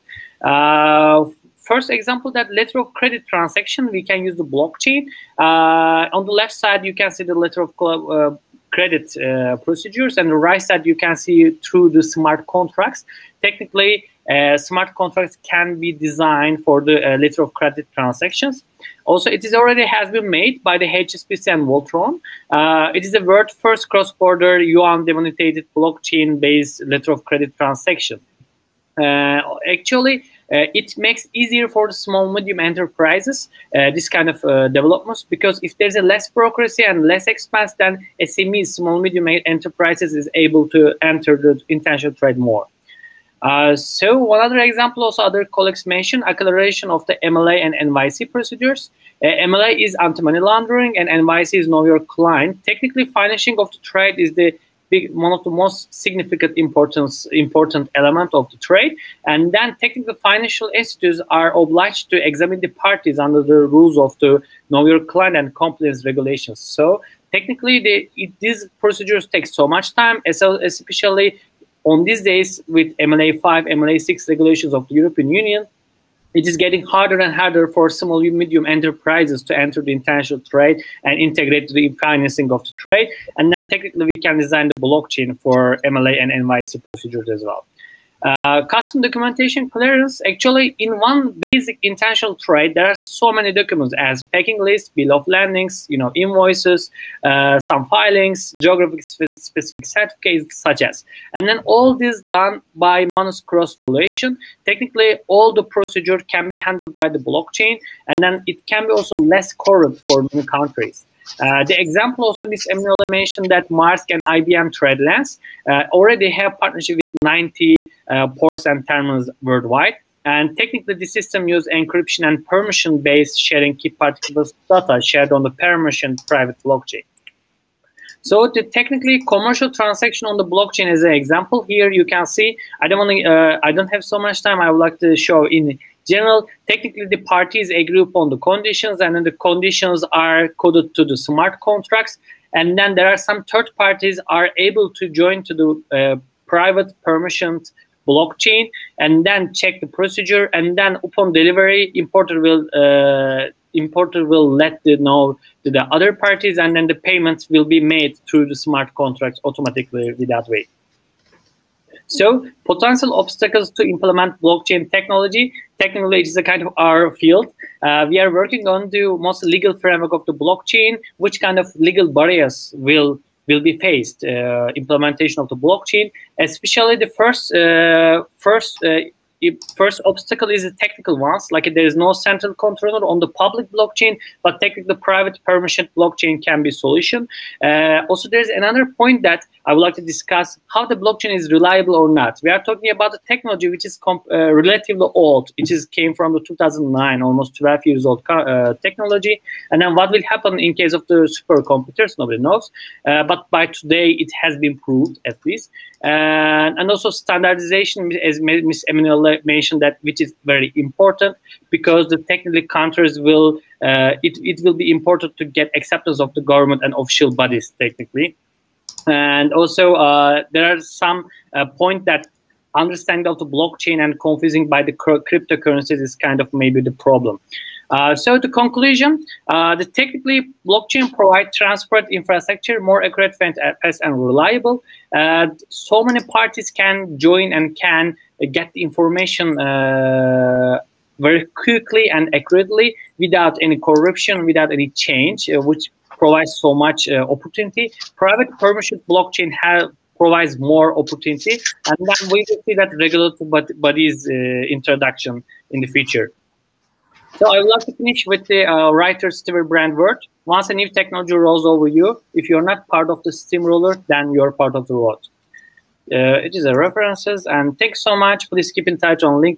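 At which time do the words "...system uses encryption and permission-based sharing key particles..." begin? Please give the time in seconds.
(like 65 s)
121 s.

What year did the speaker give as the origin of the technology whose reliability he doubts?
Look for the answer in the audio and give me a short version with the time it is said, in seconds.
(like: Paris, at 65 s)
2009, at 196 s.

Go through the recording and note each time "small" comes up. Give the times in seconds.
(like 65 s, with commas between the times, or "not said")
31 s, 38 s, 77 s.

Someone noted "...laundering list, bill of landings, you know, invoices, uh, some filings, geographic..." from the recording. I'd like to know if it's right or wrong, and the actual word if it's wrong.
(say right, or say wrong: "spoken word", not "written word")
wrong: "packing", not "laundering".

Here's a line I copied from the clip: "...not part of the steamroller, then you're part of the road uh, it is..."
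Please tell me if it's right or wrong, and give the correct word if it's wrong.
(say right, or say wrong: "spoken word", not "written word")
right.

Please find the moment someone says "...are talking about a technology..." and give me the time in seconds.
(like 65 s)
192 s.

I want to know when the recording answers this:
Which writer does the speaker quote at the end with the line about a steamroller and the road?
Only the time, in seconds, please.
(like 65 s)
259 s.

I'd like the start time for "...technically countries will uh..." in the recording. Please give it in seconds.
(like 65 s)
212 s.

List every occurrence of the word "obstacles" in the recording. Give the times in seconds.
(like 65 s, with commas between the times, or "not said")
163 s, 180 s.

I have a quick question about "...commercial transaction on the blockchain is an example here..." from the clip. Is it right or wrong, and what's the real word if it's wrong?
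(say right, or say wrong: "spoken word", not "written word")
right.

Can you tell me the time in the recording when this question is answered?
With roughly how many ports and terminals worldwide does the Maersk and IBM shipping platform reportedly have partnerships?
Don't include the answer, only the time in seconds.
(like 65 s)
117 s.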